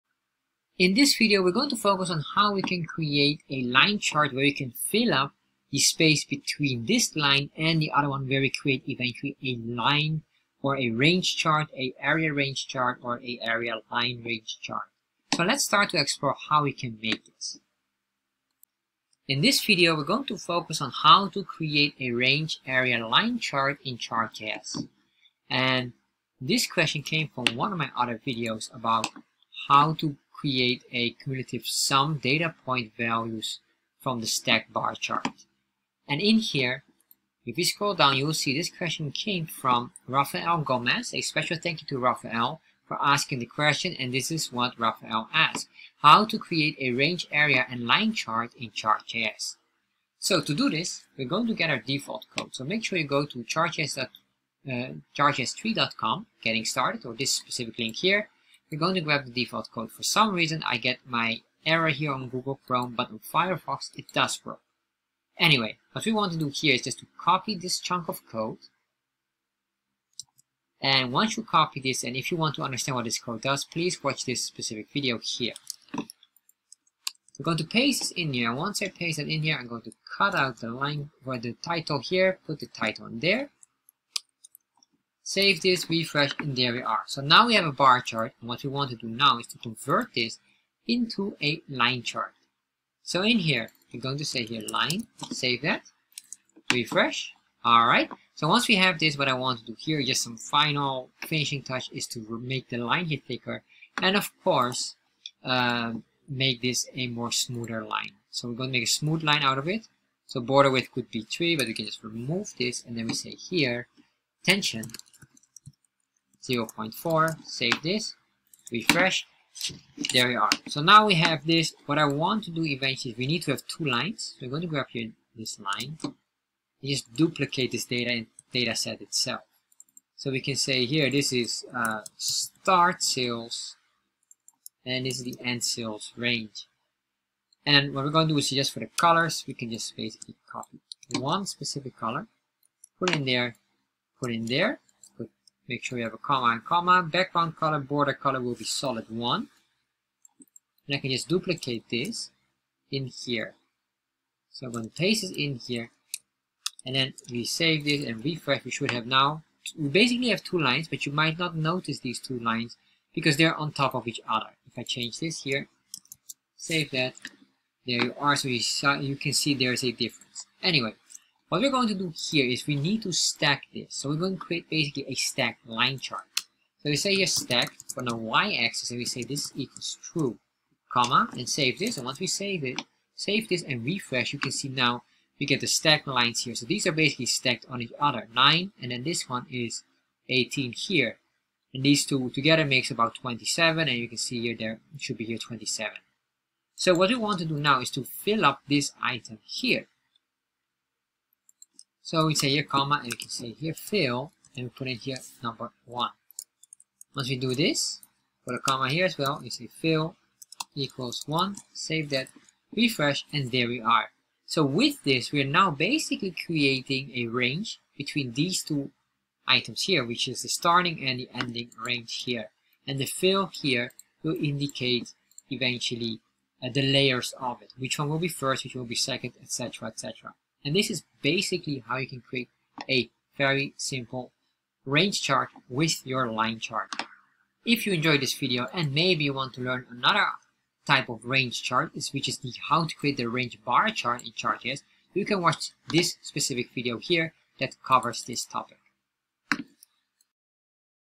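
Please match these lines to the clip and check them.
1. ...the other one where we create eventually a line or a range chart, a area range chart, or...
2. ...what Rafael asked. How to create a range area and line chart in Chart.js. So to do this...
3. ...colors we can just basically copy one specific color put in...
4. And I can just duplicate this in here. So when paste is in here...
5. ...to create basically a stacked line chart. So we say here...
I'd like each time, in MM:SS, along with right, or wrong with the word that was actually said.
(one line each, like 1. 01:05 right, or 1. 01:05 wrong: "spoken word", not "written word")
1. 00:07 right
2. 00:44 right
3. 02:18 right
4. 02:30 right
5. 02:54 right.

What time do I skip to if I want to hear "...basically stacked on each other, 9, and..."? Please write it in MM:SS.
03:06.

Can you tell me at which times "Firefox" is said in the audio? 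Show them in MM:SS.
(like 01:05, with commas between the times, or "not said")
01:03.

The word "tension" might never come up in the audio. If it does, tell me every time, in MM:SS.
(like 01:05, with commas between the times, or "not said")
01:54.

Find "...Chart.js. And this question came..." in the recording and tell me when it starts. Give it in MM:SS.
00:23.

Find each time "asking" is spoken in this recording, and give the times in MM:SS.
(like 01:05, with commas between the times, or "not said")
00:42.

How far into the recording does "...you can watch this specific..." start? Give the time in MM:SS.
04:05.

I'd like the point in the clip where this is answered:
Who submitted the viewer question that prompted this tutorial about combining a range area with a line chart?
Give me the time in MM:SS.
00:40.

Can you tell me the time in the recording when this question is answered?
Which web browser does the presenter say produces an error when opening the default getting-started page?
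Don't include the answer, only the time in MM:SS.
01:02.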